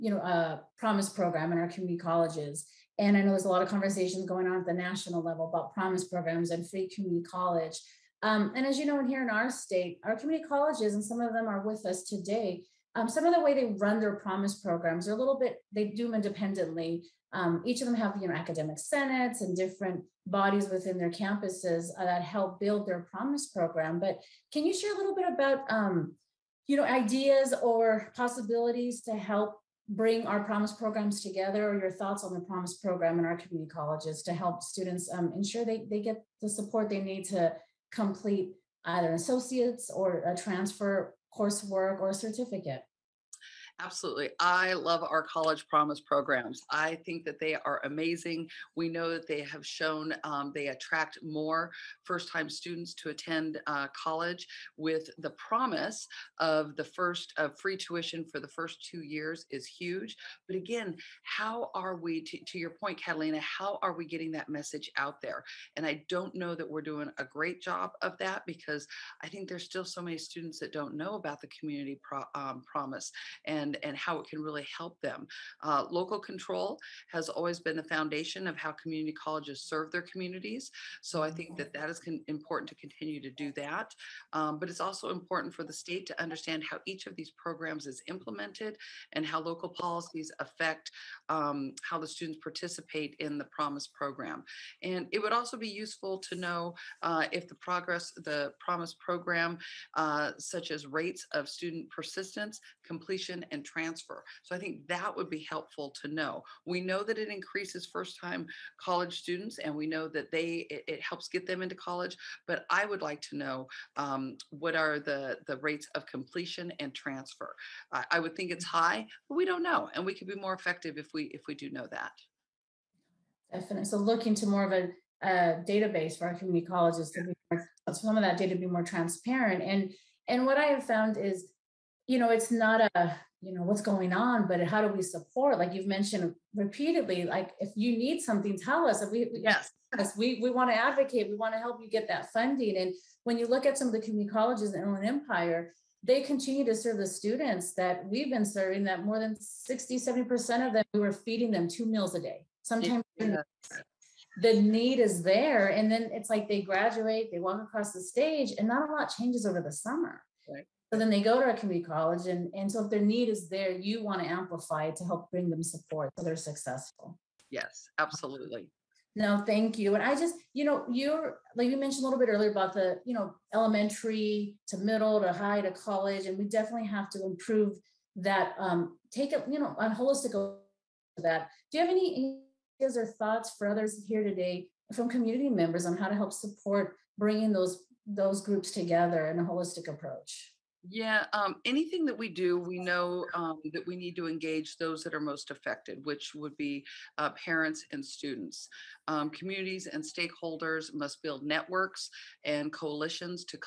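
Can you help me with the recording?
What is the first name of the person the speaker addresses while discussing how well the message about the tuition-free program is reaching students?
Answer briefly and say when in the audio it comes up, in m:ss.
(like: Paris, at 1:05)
Catalina, at 1:03.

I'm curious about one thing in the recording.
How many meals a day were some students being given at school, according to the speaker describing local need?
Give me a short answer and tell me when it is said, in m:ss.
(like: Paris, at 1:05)
2, at 2:31.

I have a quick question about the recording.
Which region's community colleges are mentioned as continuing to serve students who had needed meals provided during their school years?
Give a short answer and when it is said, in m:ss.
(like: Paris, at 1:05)
Inland Empire, at 2:24.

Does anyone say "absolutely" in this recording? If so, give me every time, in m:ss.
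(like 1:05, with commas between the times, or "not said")
0:43, 2:47.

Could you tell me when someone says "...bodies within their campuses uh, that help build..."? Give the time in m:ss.
0:20.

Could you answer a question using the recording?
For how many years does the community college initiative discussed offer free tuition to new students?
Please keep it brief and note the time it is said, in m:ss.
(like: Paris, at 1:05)
2, at 0:58.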